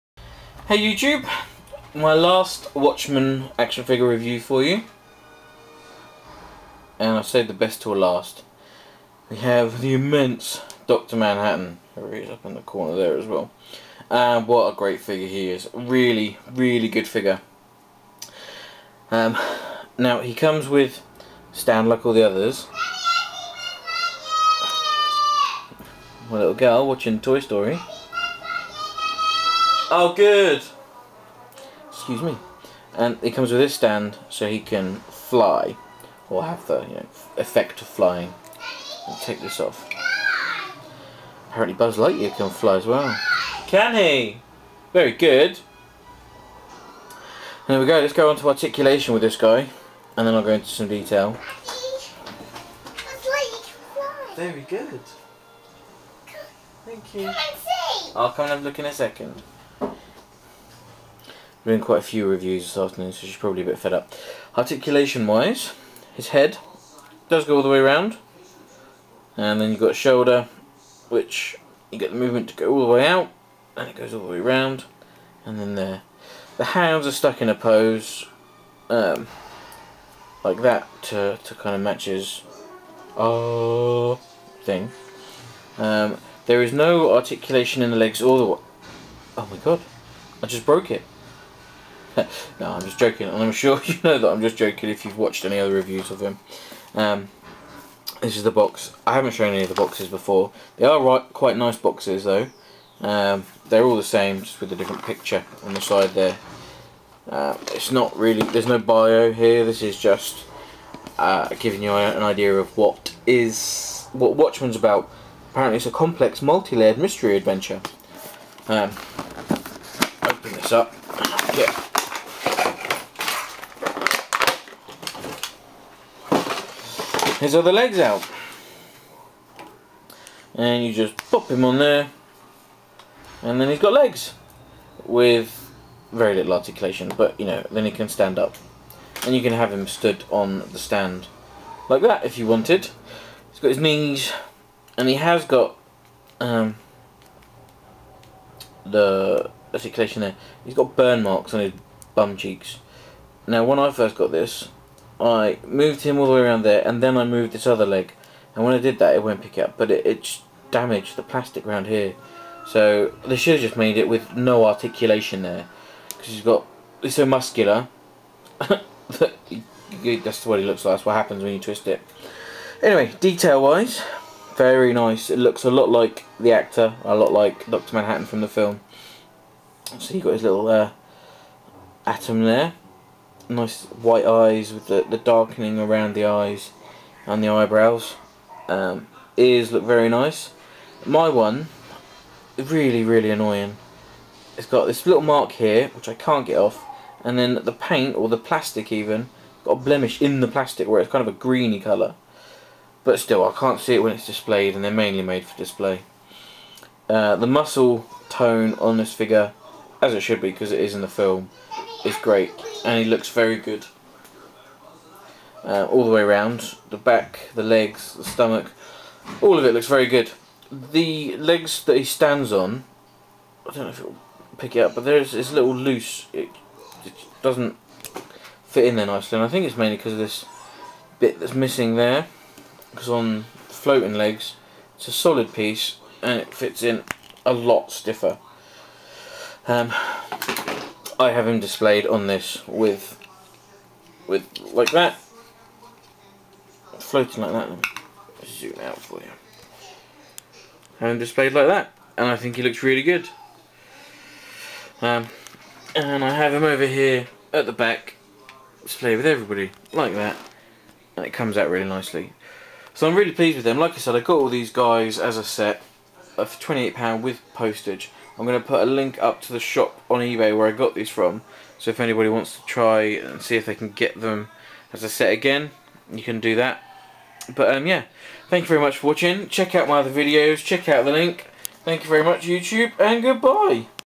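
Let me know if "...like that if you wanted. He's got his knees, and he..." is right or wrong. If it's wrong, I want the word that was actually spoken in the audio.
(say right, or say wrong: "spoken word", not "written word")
right.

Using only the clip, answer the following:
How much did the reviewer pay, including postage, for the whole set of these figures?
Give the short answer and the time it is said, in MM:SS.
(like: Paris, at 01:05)
£28, at 04:26.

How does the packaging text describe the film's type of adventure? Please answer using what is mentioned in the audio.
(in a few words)
complex, multi-layered mystery adventure.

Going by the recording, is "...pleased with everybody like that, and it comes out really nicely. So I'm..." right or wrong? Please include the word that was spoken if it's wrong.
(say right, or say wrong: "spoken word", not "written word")
wrong: "displayed", not "pleased".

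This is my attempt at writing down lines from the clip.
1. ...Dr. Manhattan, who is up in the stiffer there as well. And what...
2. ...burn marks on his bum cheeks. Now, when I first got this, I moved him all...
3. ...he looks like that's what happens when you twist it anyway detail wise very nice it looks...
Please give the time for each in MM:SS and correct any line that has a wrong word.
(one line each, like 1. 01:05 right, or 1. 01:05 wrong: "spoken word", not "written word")
1. 00:10 wrong: "corner", not "stiffer"
2. 02:30 right
3. 02:50 right.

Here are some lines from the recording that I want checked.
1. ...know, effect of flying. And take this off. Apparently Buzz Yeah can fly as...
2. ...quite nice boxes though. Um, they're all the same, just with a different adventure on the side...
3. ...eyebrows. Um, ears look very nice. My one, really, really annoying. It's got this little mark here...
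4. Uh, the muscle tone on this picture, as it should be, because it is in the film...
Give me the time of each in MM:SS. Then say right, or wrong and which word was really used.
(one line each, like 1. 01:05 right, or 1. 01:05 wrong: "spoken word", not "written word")
1. 00:36 wrong: "Lightyear", not "Yeah"
2. 01:41 wrong: "picture", not "adventure"
3. 03:07 right
4. 03:27 wrong: "figure", not "picture".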